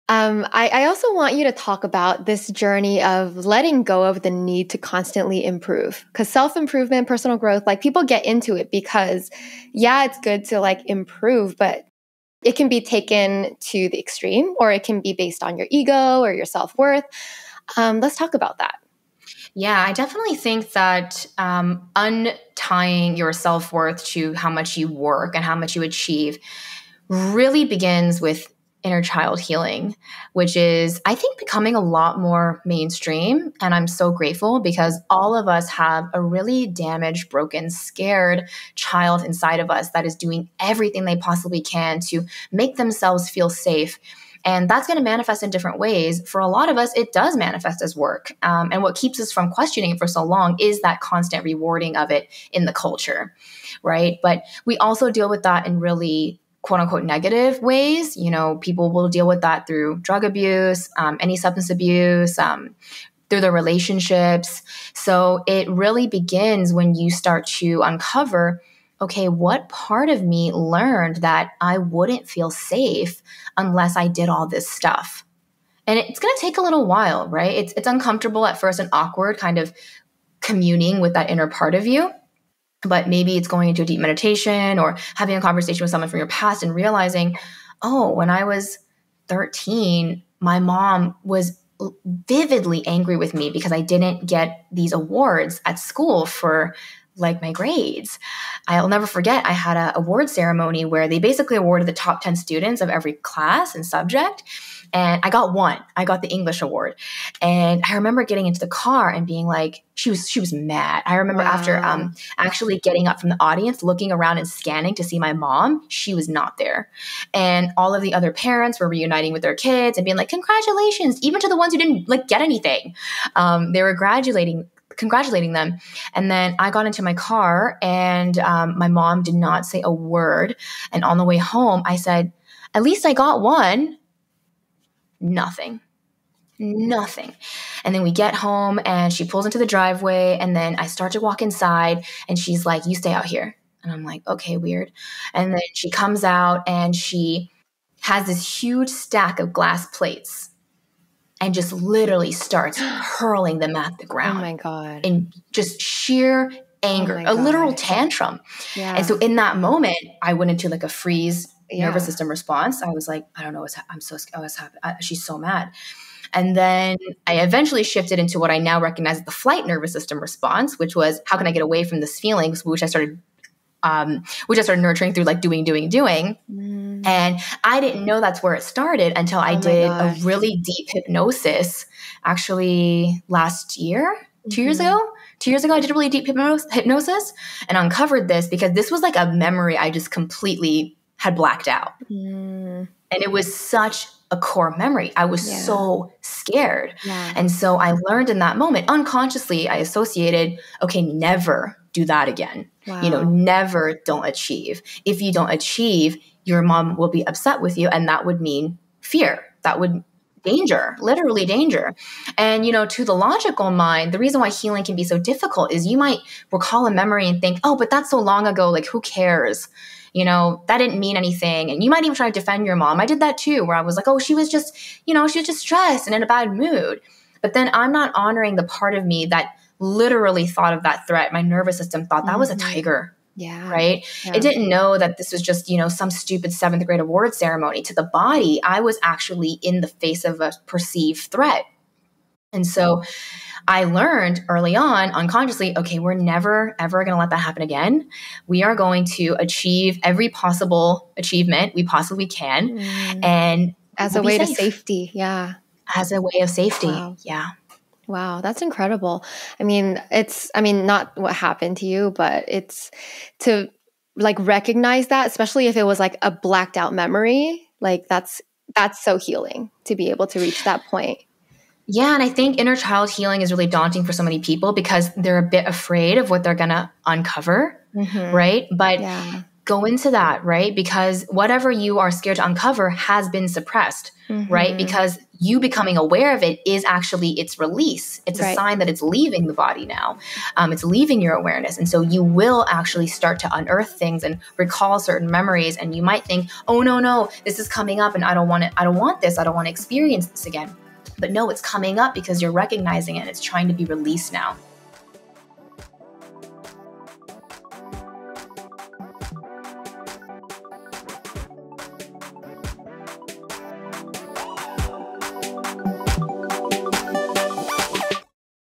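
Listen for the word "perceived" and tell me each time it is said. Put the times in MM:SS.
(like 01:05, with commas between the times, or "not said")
04:00.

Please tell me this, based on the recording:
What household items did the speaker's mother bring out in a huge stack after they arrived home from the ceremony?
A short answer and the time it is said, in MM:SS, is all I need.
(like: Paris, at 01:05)
glass plates, at 02:29.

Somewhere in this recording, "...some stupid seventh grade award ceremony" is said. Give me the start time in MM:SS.
03:55.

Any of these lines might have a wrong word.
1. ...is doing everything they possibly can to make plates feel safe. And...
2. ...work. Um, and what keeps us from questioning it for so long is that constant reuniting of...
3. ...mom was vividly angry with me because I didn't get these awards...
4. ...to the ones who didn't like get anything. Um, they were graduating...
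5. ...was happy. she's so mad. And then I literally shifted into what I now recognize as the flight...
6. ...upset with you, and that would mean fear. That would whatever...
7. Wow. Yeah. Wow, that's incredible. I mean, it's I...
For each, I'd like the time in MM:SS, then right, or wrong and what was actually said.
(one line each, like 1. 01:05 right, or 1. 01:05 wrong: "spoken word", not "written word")
1. 00:40 wrong: "themselves", not "plates"
2. 00:47 wrong: "rewarding", not "reuniting"
3. 01:30 right
4. 02:01 right
5. 02:44 wrong: "eventually", not "literally"
6. 03:27 wrong: "danger", not "whatever"
7. 04:16 right.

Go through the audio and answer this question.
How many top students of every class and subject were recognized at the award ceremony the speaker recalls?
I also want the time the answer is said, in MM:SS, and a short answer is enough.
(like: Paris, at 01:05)
10, at 01:41.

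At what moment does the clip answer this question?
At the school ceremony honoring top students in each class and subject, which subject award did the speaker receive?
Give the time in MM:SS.
01:46.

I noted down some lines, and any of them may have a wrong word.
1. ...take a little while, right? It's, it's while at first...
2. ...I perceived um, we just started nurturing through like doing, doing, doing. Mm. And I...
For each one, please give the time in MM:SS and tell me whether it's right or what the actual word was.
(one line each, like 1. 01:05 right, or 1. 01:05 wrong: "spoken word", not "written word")
1. 01:16 wrong: "uncomfortable", not "while"
2. 02:52 wrong: "started", not "perceived".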